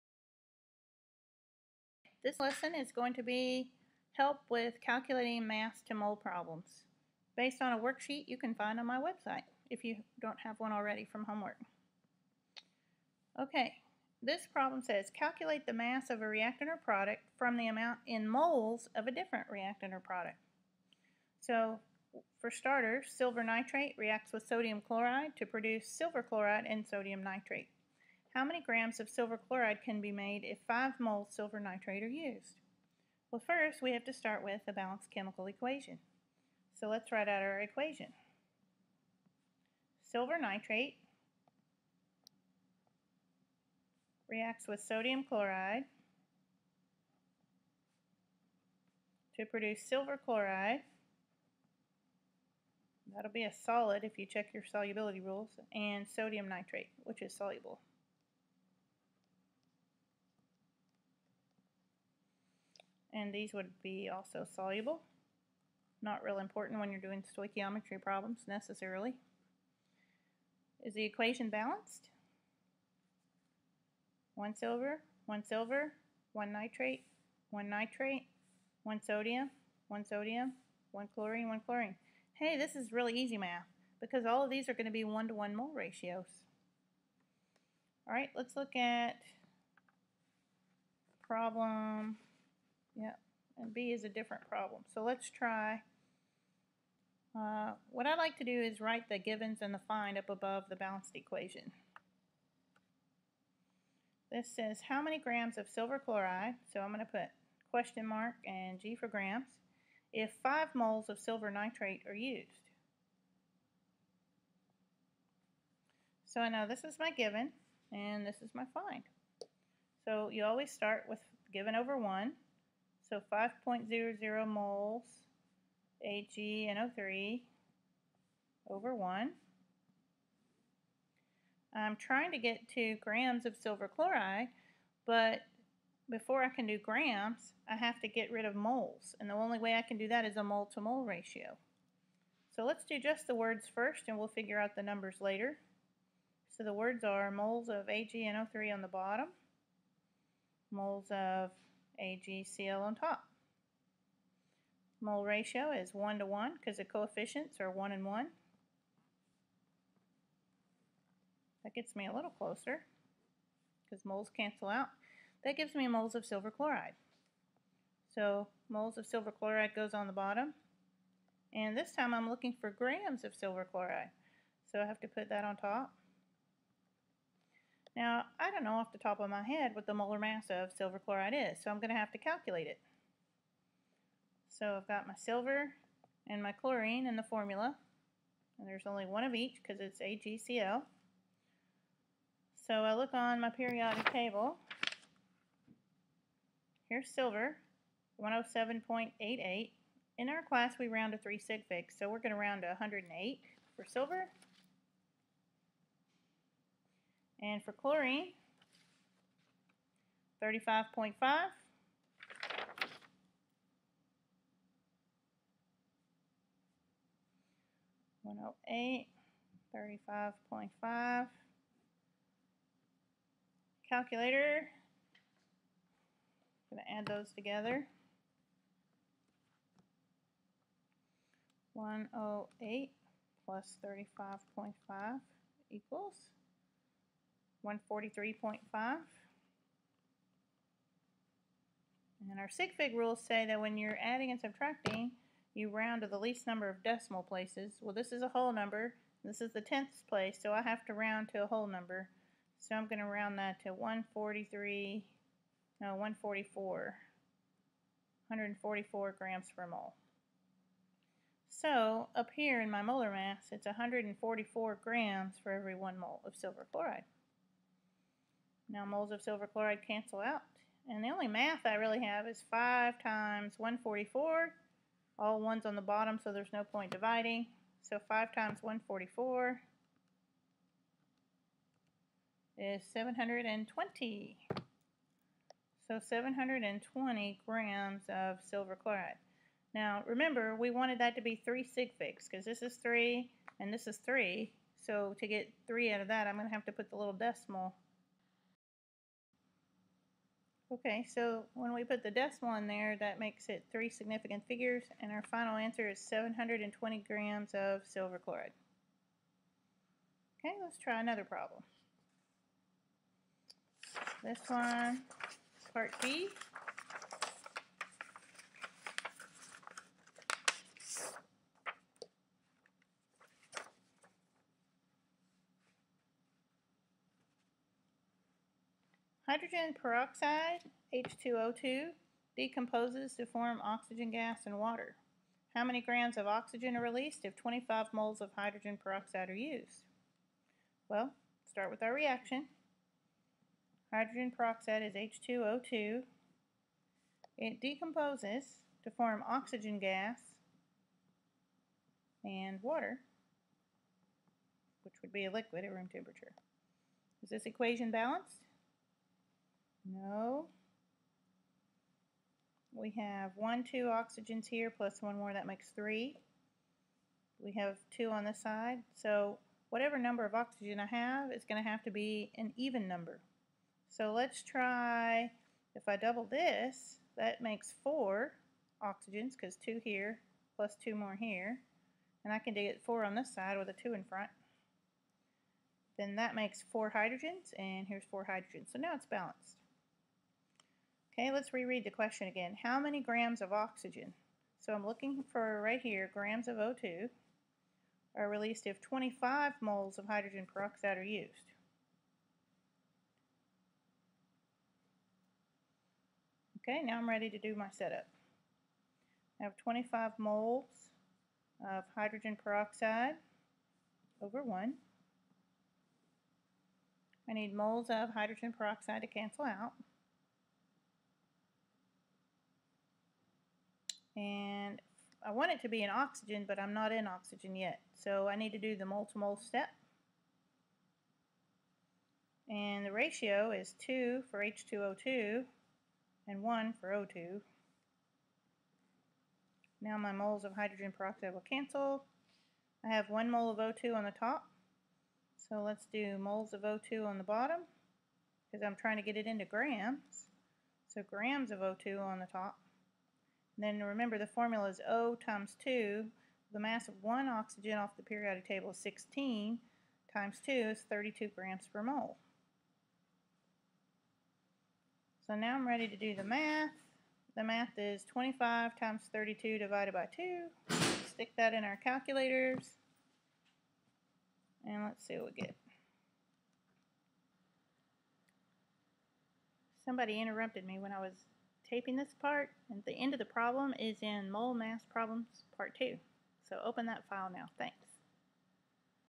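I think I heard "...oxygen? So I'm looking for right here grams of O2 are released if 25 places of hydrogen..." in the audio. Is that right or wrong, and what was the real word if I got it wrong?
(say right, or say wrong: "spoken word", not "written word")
wrong: "moles", not "places".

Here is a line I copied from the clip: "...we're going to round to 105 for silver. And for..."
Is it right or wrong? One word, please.
wrong.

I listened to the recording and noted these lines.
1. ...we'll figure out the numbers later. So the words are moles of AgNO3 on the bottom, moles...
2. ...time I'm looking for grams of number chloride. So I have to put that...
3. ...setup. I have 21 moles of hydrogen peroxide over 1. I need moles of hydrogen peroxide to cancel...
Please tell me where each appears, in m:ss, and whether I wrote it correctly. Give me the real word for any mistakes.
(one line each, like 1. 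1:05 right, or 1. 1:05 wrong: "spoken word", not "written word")
1. 2:24 right
2. 2:51 wrong: "silver", not "number"
3. 6:47 wrong: "25", not "21".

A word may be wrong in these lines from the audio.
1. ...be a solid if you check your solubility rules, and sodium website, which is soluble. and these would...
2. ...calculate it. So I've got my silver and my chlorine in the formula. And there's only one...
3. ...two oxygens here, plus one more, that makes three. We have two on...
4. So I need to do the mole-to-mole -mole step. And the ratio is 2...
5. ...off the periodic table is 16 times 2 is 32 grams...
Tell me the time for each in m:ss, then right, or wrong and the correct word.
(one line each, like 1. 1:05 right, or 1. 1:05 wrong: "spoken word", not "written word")
1. 0:53 wrong: "nitrate", not "website"
2. 3:02 right
3. 6:03 right
4. 7:07 right
5. 7:37 right.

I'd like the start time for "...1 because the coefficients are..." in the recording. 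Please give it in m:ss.
2:36.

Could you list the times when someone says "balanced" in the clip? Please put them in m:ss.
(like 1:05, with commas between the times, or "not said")
0:34, 1:11, 1:40, 5:57, 6:29.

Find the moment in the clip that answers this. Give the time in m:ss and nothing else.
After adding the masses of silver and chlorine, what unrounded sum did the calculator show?
3:57.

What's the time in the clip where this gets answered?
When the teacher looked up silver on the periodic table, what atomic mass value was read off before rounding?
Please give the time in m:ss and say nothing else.
3:18.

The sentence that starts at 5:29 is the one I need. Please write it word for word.
Hydrogen peroxide, H2O2, decomposes to form oxygen gas and water.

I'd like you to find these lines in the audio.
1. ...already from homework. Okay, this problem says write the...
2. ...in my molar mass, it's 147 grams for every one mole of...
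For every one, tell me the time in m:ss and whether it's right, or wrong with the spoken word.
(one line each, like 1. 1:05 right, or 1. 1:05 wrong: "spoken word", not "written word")
1. 0:10 wrong: "calculate", not "write"
2. 4:22 wrong: "144", not "147".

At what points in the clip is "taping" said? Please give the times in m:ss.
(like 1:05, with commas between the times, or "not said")
8:01.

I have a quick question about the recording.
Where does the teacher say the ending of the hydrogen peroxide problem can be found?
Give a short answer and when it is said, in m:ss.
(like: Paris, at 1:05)
Mole mass problems part 2, at 8:04.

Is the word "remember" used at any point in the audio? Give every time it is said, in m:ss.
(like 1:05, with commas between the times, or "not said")
4:50, 7:33.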